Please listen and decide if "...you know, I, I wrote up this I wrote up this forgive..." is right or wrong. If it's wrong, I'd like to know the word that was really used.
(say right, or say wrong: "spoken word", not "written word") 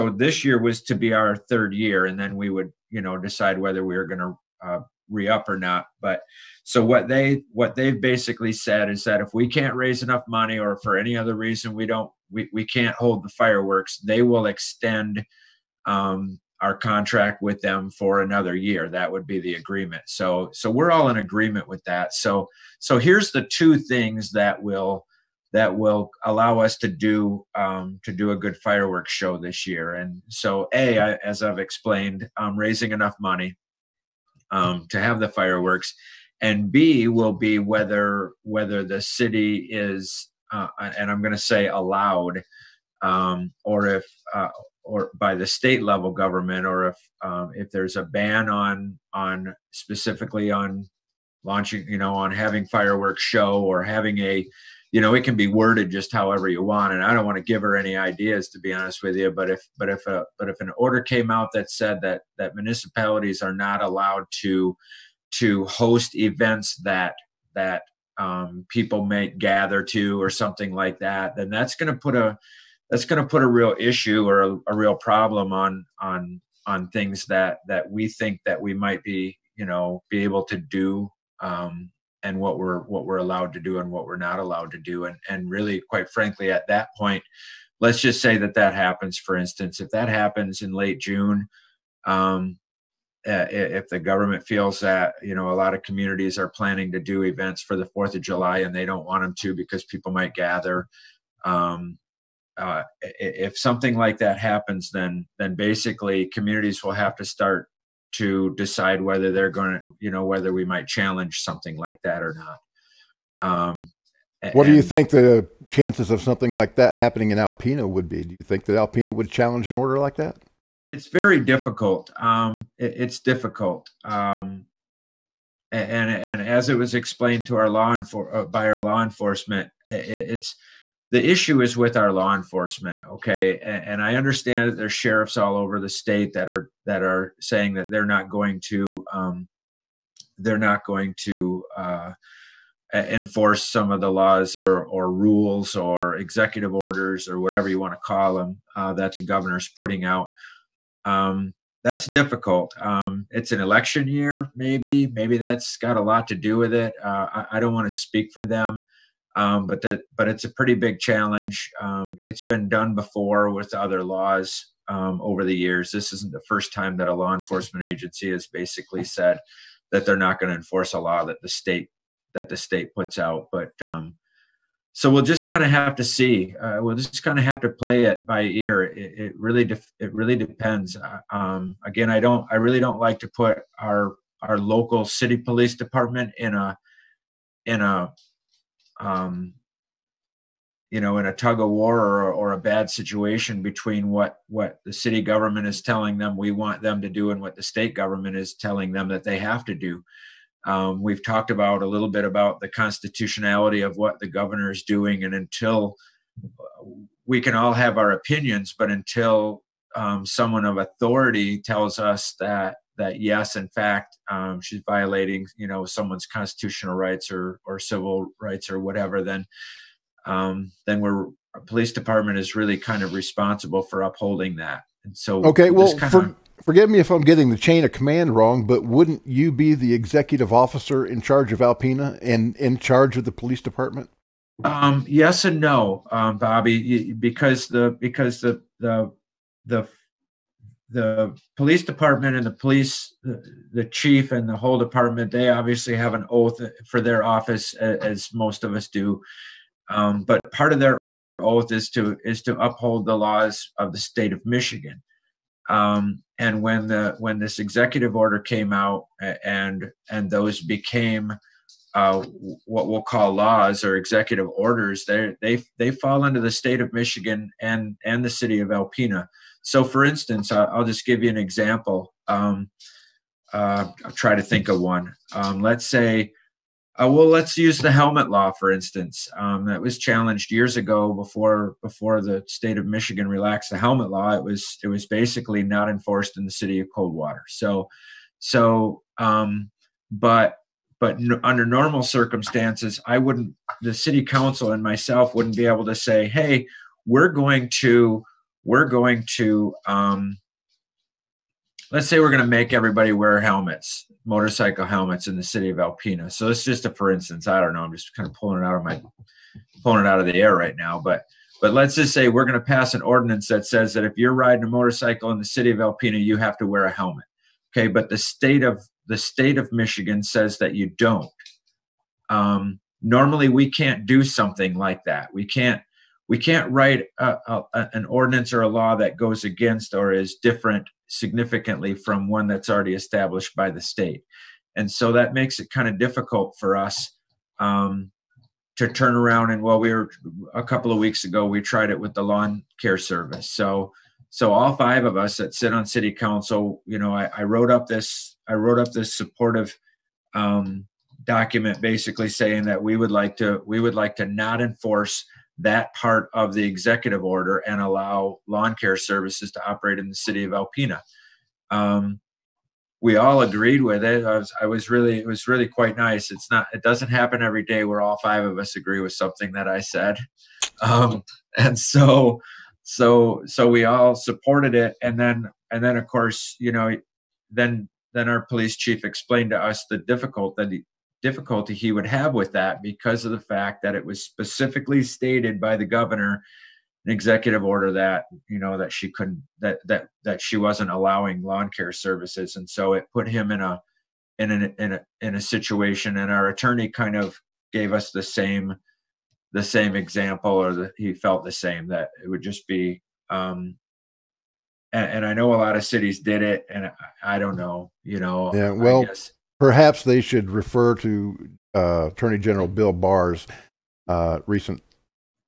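wrong: "supportive", not "forgive".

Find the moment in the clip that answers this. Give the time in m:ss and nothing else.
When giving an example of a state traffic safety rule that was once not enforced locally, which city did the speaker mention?
4:46.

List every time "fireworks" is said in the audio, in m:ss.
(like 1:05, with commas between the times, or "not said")
0:13, 0:28, 0:35, 0:52.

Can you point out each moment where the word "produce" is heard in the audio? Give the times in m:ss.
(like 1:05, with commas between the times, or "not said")
not said.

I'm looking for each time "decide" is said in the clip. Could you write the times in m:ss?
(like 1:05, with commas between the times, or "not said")
0:03, 1:48.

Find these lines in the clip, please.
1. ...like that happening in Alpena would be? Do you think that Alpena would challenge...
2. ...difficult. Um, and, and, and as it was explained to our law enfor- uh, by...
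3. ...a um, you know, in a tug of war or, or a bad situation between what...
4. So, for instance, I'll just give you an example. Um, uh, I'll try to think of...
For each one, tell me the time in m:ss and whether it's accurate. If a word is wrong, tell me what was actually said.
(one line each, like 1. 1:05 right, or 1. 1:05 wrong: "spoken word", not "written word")
1. 1:56 right
2. 2:03 right
3. 3:07 right
4. 4:29 right.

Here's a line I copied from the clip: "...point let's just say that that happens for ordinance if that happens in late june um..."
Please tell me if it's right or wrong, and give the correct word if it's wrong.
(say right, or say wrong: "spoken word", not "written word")
wrong: "instance", not "ordinance".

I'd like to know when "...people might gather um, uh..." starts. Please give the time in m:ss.
1:39.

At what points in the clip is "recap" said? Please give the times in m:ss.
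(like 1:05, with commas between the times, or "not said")
not said.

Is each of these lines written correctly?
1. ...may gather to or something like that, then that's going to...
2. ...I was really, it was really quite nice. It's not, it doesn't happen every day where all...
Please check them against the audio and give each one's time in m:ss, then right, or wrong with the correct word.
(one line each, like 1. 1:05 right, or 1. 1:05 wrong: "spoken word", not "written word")
1. 1:09 right
2. 6:04 right.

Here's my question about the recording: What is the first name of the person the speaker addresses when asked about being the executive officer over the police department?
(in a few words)
Bobby.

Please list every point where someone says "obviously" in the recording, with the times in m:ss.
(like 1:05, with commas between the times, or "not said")
4:05.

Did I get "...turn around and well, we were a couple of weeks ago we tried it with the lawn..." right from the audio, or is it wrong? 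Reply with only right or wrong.
right.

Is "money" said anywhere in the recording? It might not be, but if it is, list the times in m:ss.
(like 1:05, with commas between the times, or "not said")
0:10, 0:33.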